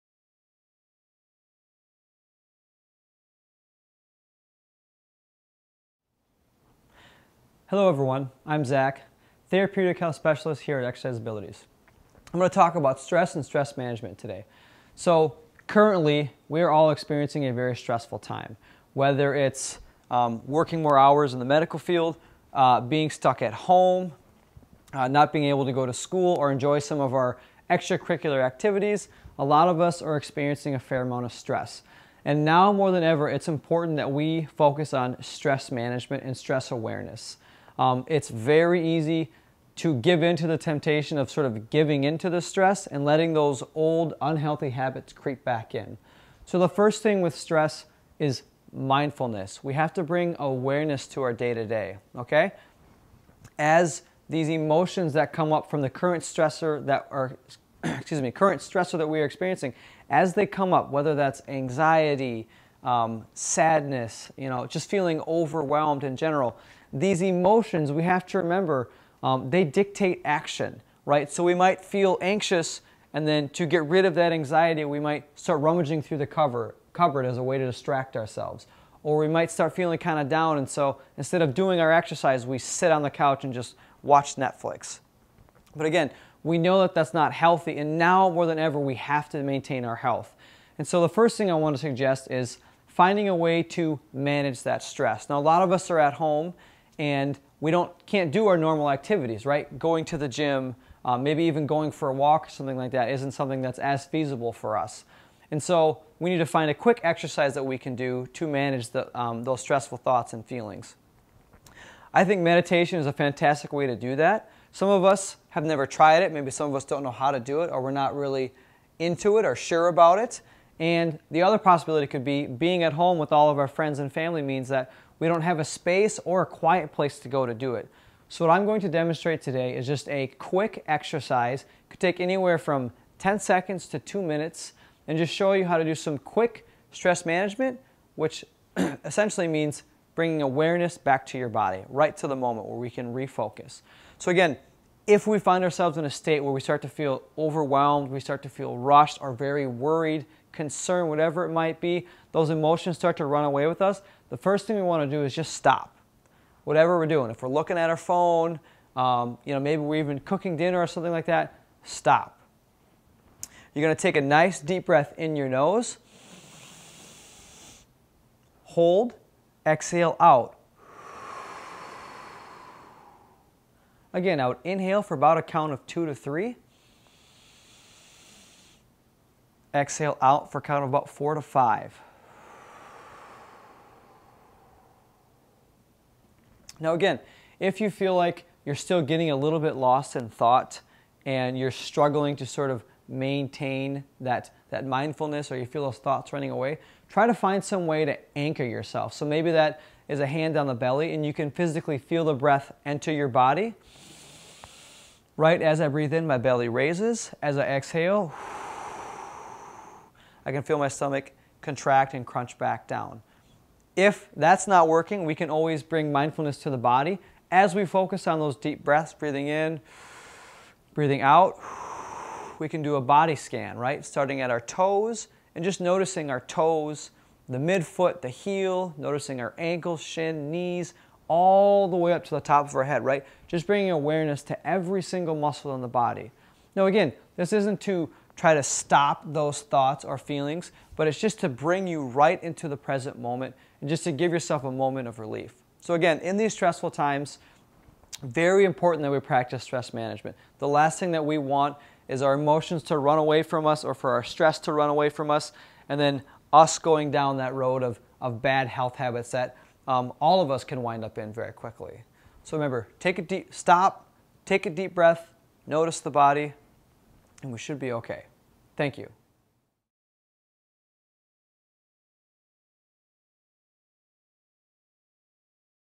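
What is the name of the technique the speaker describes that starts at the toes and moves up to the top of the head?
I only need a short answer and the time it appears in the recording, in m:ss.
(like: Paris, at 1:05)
body scan, at 3:43.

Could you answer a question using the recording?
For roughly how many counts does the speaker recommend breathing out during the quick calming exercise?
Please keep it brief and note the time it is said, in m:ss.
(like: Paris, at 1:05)
4 to 5, at 3:01.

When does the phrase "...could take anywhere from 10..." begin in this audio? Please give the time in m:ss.
2:11.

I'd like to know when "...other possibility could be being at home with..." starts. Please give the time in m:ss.
2:01.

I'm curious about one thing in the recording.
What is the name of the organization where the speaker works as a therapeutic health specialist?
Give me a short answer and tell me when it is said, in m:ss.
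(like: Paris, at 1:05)
Exercise Abilities, at 0:10.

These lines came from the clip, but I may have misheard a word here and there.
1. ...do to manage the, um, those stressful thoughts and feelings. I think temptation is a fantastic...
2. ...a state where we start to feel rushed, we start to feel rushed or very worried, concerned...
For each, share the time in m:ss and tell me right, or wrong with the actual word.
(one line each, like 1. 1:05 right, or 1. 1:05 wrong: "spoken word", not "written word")
1. 1:47 wrong: "meditation", not "temptation"
2. 2:26 wrong: "overwhelmed", not "rushed".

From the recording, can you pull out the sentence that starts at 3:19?
So maybe that is a hand on the belly and you can physically feel the breath enter your body.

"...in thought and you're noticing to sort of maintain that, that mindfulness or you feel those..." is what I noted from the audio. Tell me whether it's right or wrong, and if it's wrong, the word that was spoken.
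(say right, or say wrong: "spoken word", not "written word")
wrong: "struggling", not "noticing".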